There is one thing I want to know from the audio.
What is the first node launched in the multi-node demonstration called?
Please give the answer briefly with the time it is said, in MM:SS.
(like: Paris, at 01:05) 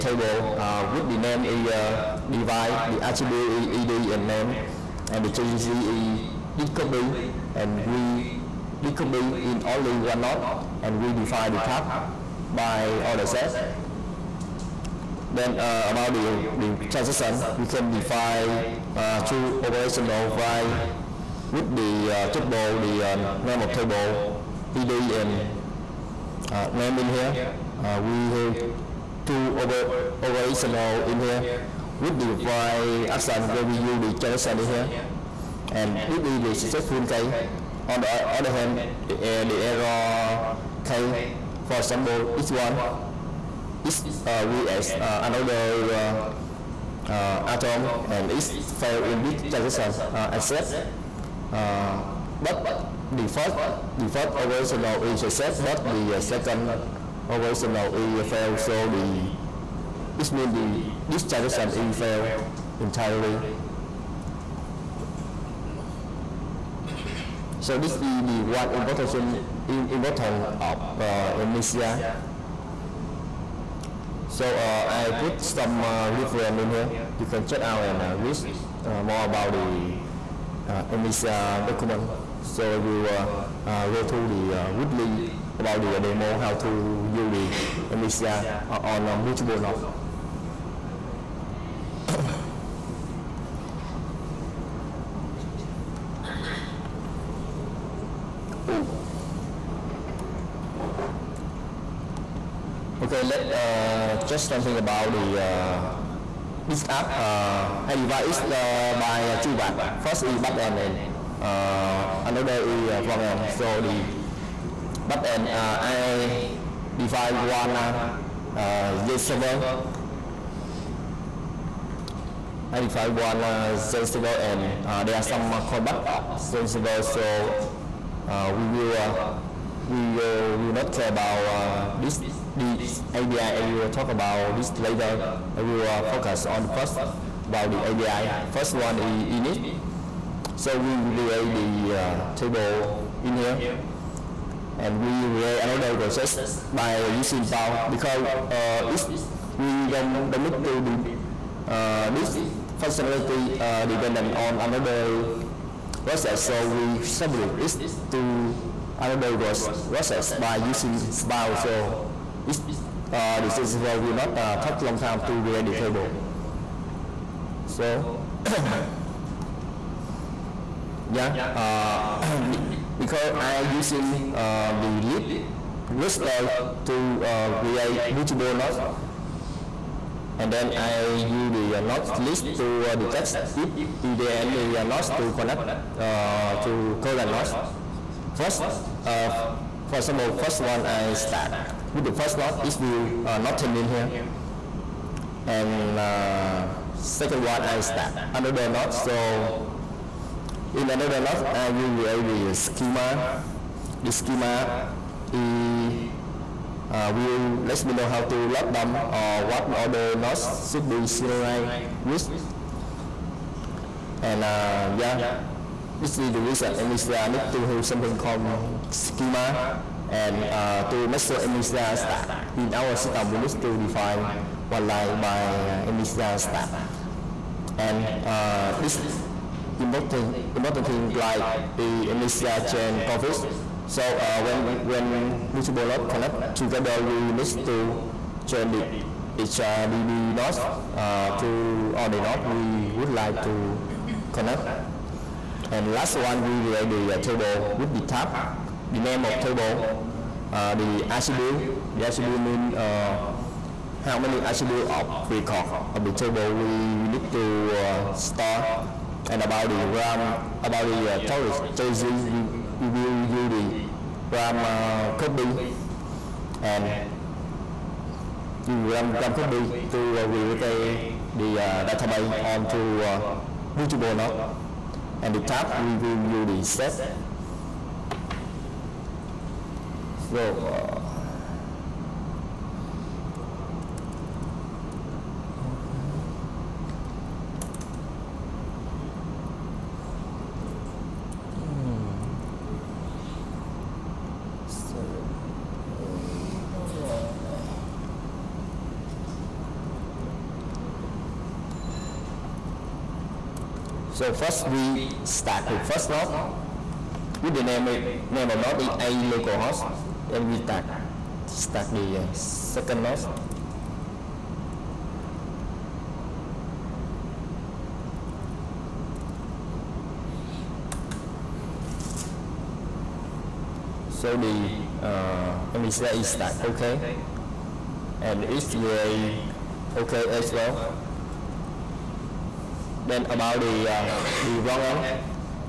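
localhost, at 05:09.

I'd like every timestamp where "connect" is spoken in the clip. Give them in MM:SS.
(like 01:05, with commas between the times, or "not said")
03:05, 03:56, 04:04.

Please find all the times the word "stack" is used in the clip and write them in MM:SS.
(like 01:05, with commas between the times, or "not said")
03:41, 03:46.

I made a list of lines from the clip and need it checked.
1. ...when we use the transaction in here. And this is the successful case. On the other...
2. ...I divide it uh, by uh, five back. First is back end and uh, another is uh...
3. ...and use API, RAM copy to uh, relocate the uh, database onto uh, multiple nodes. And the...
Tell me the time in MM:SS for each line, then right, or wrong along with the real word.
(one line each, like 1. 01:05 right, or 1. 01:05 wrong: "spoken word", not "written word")
1. 00:33 right
2. 01:47 wrong: "two", not "five"
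3. 04:26 wrong: "RAM", not "API".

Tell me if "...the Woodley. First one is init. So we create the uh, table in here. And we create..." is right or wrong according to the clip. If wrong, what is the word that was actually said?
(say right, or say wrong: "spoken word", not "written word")
wrong: "API", not "Woodley".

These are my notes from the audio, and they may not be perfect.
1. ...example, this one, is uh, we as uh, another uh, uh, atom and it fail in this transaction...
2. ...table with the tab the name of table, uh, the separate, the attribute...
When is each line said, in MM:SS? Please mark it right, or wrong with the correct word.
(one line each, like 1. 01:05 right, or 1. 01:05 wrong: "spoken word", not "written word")
1. 00:41 right
2. 04:07 wrong: "attribute", not "separate".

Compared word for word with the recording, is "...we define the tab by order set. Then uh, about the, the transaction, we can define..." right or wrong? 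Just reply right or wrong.
right.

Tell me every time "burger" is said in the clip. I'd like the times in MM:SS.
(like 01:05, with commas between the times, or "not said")
not said.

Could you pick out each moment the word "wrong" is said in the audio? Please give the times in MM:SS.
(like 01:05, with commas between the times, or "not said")
05:34.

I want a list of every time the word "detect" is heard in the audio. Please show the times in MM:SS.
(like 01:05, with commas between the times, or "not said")
03:02.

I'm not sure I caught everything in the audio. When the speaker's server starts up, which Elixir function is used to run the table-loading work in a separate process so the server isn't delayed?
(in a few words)
spawn.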